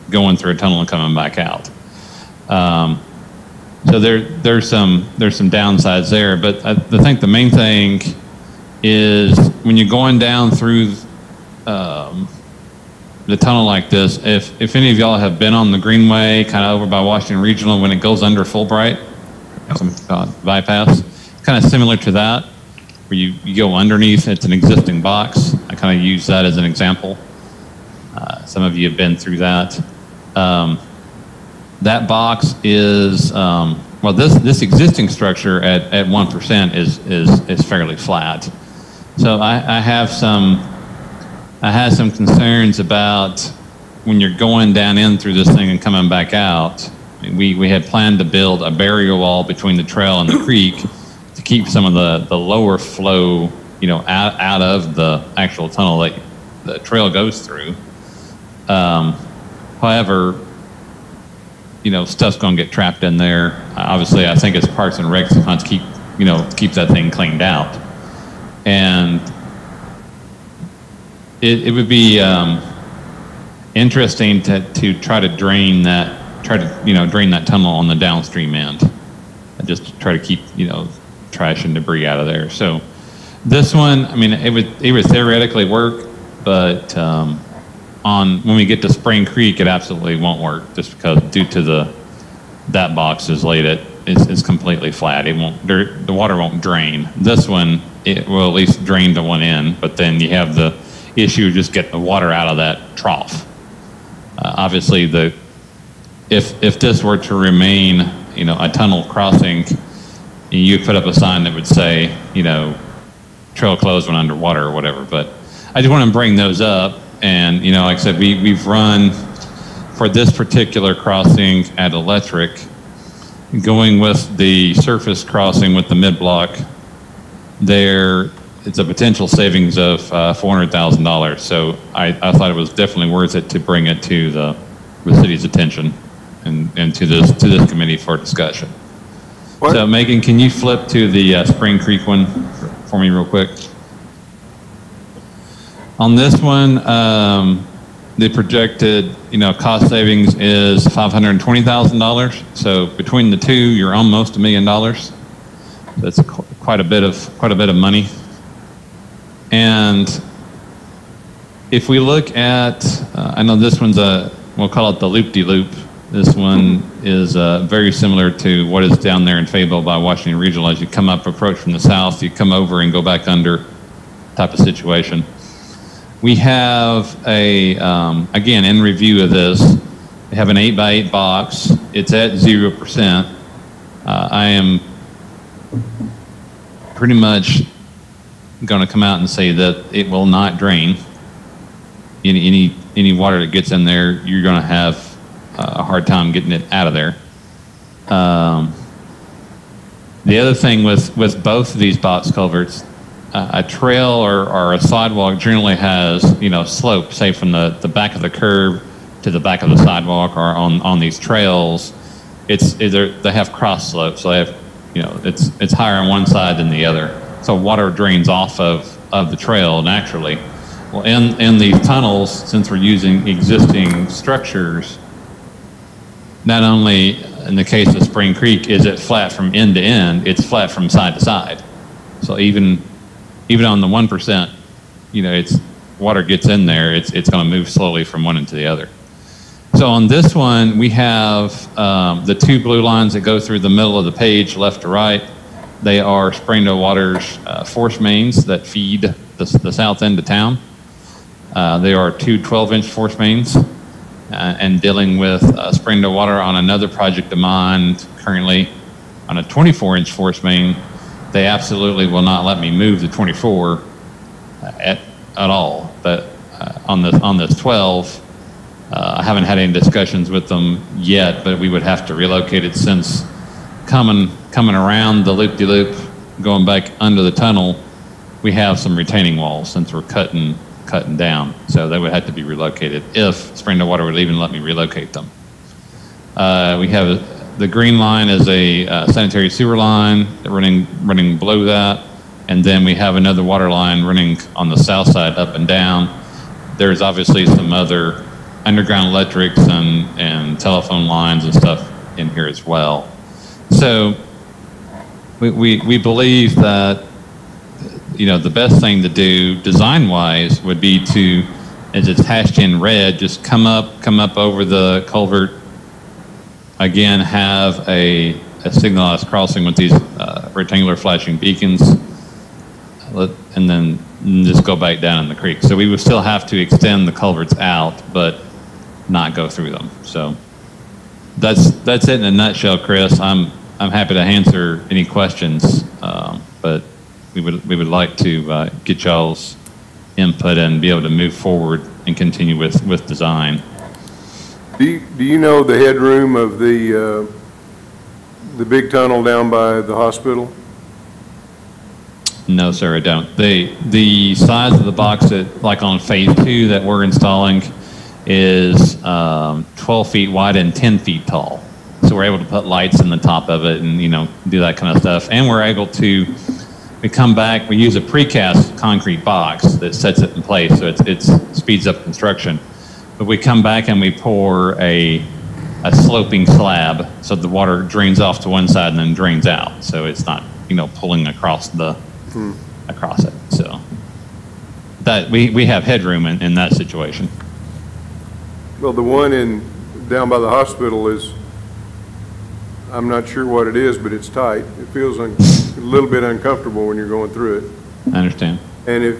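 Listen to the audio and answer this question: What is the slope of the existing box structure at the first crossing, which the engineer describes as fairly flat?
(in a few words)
1%.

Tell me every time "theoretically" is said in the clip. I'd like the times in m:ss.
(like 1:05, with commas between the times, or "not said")
1:25.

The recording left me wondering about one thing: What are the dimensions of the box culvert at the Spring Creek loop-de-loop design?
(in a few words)
8 by 8.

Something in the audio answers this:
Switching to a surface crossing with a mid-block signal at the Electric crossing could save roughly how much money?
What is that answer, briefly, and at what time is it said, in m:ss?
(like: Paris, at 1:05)
$400,000, at 2:10.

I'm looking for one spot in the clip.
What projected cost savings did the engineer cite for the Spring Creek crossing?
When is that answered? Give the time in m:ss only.
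2:30.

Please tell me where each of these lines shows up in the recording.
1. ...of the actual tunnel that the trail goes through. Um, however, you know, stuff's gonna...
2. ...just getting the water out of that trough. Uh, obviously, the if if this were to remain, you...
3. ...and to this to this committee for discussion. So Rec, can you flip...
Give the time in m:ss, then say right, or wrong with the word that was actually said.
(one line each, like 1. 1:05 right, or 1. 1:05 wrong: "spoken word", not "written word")
1. 0:54 right
2. 1:41 right
3. 2:16 wrong: "Megan", not "Rec".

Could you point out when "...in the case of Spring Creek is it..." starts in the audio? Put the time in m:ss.
3:47.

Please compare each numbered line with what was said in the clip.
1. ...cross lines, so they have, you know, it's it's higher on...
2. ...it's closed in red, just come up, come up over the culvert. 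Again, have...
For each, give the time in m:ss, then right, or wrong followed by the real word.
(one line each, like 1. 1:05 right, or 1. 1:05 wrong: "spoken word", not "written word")
1. 3:33 wrong: "slopes", not "lines"
2. 5:12 wrong: "hashed", not "closed".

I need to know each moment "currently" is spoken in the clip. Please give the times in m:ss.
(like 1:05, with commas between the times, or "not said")
4:18.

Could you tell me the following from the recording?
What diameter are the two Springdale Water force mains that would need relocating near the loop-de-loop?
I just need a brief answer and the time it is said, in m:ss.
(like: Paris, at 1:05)
12-inch, at 4:12.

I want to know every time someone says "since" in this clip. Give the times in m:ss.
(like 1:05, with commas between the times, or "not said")
3:42, 4:32, 4:39.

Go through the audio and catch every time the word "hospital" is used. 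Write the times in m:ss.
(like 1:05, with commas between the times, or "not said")
5:49, 6:30.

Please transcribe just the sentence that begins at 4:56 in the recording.
There's obviously some other underground electrics and, and telephone lines and stuff in here as well.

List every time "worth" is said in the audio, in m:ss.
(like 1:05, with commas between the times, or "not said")
2:13.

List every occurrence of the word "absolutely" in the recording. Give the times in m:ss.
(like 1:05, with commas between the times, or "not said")
1:29, 4:21.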